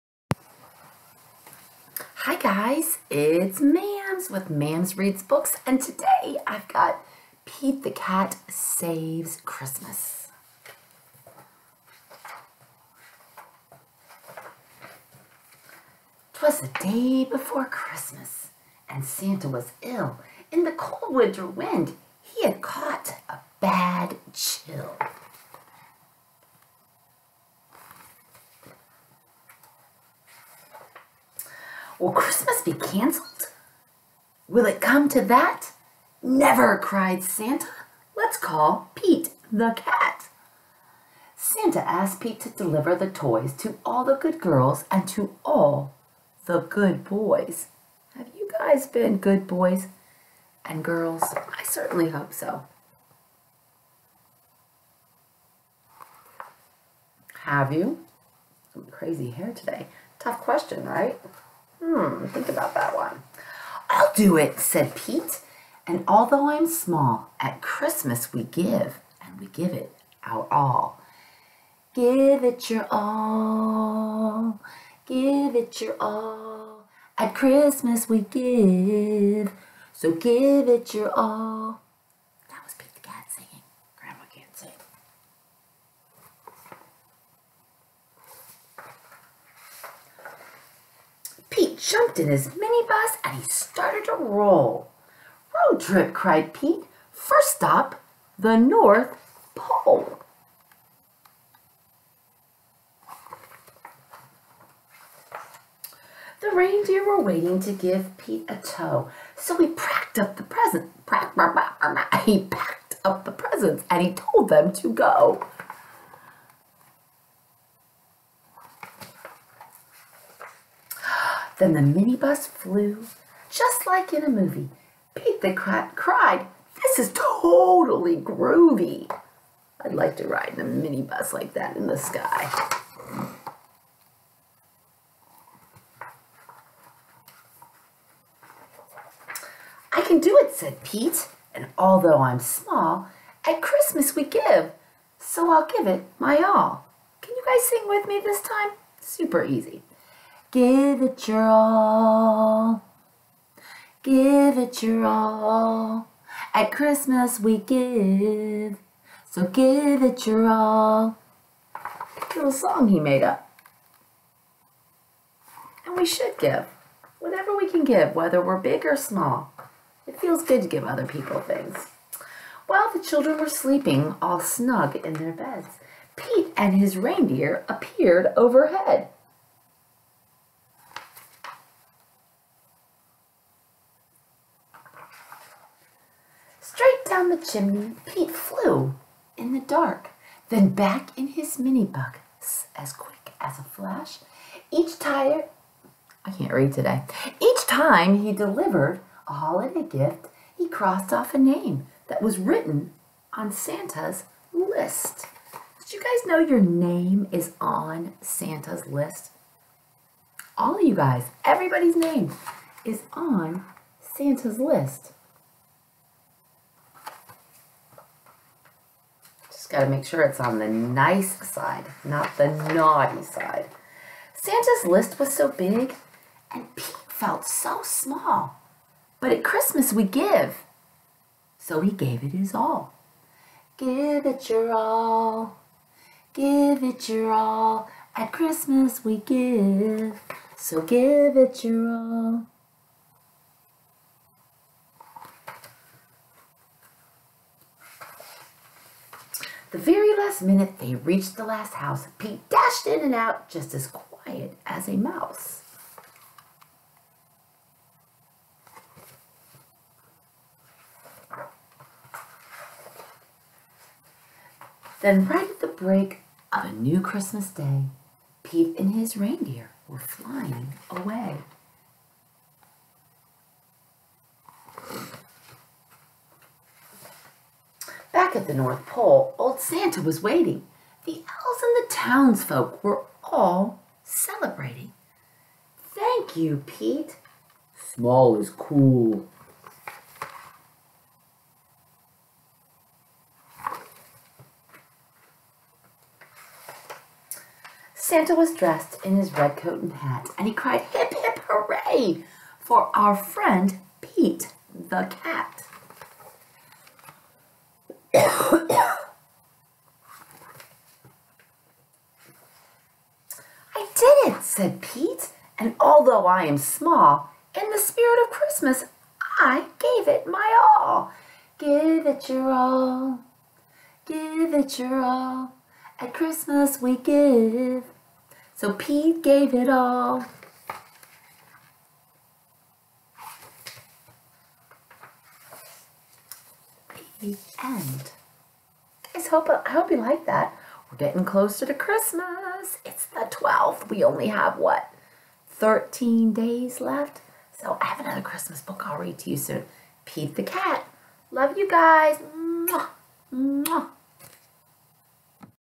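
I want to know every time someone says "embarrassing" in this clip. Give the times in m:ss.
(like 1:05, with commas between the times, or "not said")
not said.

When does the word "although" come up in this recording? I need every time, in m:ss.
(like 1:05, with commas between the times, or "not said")
1:06, 2:21, 5:15.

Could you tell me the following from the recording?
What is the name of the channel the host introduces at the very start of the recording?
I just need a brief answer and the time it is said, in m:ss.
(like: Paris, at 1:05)
Mams Reads Books, at 0:04.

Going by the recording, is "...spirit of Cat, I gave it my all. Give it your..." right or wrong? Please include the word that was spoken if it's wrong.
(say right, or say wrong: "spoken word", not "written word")
wrong: "Christmas", not "Cat".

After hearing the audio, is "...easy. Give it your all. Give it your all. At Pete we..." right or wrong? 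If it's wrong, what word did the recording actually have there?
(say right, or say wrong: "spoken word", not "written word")
wrong: "Christmas", not "Pete".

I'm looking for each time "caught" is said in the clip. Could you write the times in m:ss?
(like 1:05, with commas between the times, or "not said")
0:22.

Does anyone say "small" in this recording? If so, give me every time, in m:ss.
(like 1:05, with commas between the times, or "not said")
1:06, 2:22, 2:48, 3:47, 4:47, 5:16.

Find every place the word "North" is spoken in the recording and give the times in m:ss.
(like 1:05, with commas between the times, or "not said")
1:38, 4:38.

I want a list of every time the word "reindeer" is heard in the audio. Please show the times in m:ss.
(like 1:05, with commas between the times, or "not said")
1:46, 2:56, 4:29.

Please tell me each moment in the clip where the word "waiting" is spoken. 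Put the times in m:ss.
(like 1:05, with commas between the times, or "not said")
1:47, 4:40.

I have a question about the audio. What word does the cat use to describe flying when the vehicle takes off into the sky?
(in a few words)
groovy.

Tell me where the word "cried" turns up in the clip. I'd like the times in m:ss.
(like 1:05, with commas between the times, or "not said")
0:36, 1:36, 2:05, 5:00.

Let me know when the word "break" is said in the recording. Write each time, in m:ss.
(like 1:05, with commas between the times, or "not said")
4:25.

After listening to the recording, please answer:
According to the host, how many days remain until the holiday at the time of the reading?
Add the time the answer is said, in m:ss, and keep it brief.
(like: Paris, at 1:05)
13, at 5:45.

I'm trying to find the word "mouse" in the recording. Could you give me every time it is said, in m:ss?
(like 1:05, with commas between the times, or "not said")
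4:14.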